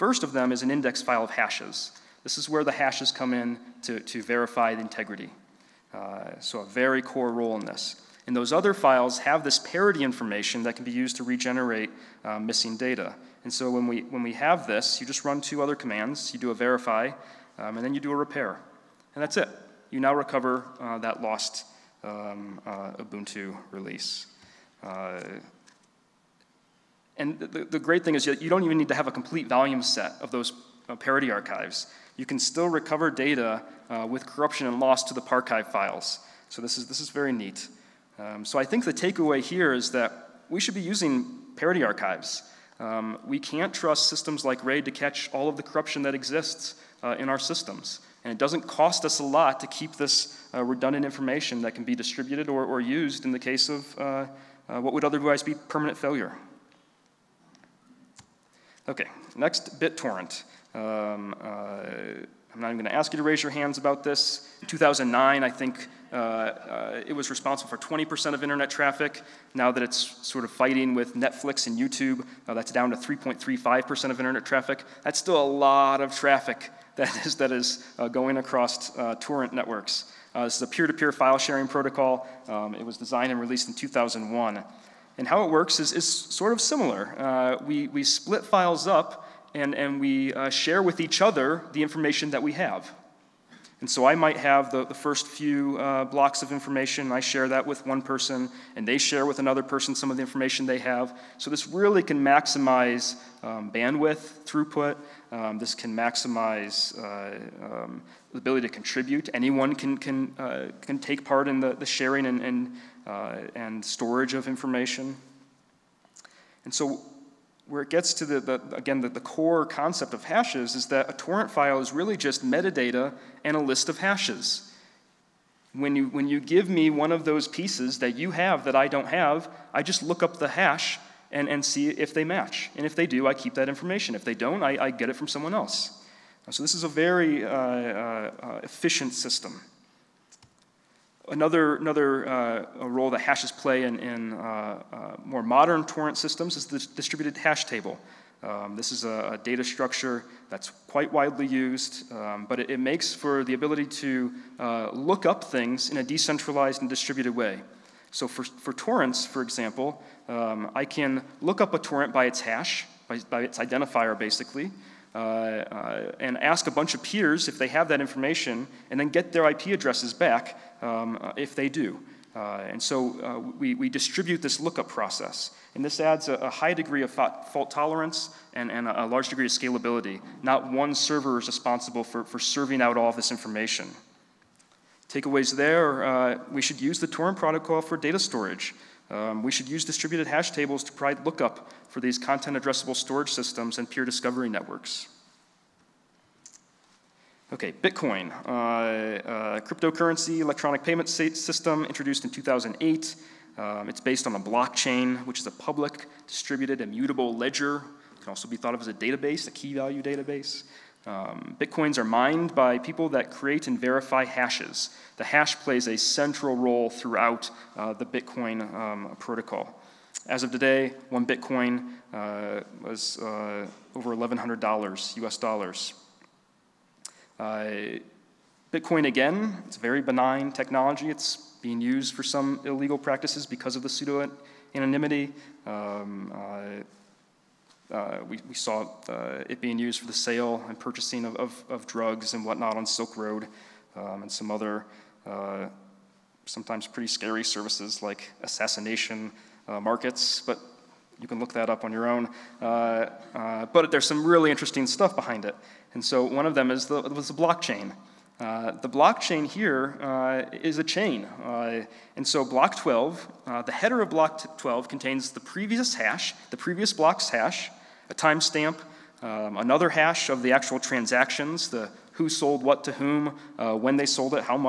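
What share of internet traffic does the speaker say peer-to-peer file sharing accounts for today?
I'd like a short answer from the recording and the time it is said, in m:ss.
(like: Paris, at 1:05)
3.35%, at 1:12.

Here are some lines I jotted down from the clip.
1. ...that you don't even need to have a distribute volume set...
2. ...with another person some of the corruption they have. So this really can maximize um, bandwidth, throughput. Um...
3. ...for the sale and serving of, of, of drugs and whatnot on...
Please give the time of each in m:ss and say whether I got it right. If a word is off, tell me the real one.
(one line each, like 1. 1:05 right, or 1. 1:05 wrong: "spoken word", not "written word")
1. 0:28 wrong: "complete", not "distribute"
2. 1:39 wrong: "information", not "corruption"
3. 3:59 wrong: "purchasing", not "serving".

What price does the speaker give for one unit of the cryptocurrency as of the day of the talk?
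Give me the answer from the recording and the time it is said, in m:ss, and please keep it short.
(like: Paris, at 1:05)
over $1,100, at 3:43.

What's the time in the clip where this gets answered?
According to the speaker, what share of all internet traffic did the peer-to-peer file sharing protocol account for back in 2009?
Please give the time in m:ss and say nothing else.
1:07.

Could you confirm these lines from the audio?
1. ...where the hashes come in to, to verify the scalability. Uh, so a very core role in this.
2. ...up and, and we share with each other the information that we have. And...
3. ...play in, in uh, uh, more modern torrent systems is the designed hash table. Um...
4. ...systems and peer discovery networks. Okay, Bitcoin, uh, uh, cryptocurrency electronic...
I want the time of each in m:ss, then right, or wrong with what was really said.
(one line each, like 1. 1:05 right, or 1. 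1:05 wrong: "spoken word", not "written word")
1. 0:02 wrong: "integrity", not "scalability"
2. 1:28 right
3. 2:23 wrong: "distributed", not "designed"
4. 3:13 right.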